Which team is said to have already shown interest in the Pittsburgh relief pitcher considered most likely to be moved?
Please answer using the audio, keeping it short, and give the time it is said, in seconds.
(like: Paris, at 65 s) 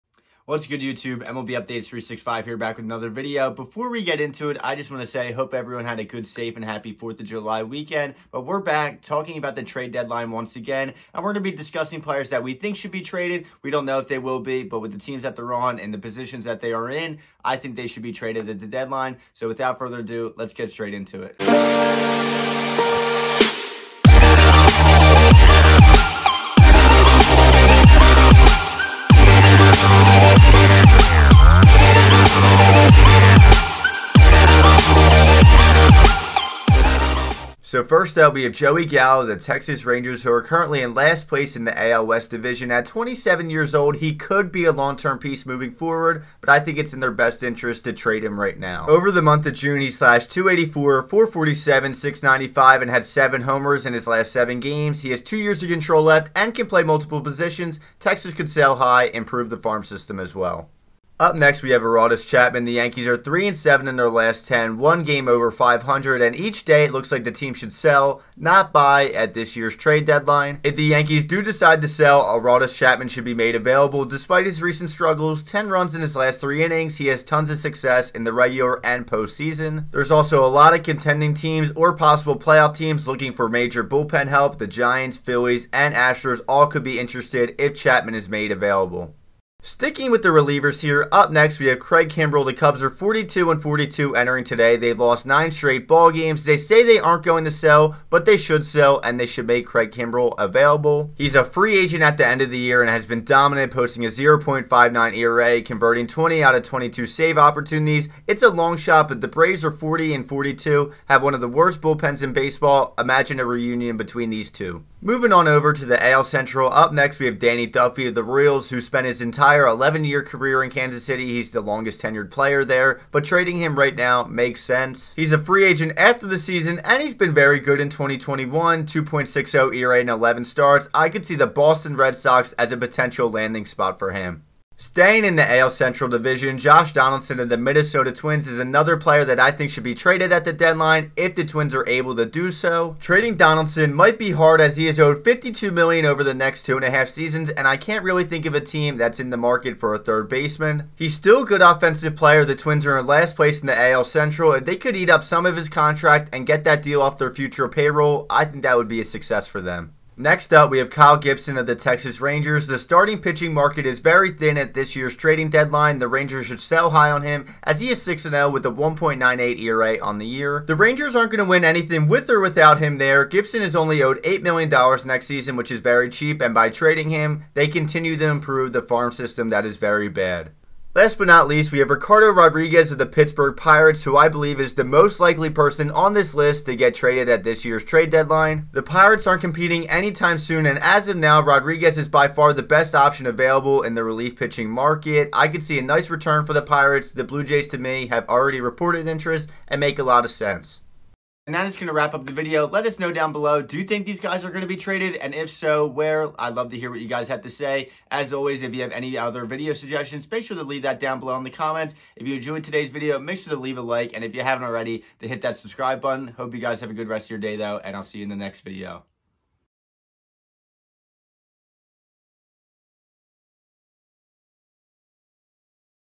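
Blue Jays, at 197 s.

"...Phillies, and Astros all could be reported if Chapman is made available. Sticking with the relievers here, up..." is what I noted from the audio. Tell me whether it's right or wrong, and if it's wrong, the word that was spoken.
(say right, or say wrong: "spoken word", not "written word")
wrong: "interested", not "reported".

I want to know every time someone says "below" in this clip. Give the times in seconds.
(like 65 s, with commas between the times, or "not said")
203 s, 211 s.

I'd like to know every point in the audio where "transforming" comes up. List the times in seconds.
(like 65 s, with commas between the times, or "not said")
not said.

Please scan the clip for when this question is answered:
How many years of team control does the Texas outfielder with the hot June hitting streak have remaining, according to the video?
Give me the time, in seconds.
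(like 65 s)
55 s.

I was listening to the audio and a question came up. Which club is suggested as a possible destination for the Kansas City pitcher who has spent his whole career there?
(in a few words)
Boston Red Sox.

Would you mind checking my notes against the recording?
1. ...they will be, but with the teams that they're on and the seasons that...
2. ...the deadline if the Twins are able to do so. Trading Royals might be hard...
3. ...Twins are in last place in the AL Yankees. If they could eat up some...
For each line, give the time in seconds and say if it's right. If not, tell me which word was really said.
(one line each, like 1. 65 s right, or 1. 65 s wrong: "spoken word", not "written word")
1. 14 s wrong: "positions", not "seasons"
2. 140 s wrong: "Donaldson", not "Royals"
3. 152 s wrong: "Central", not "Yankees".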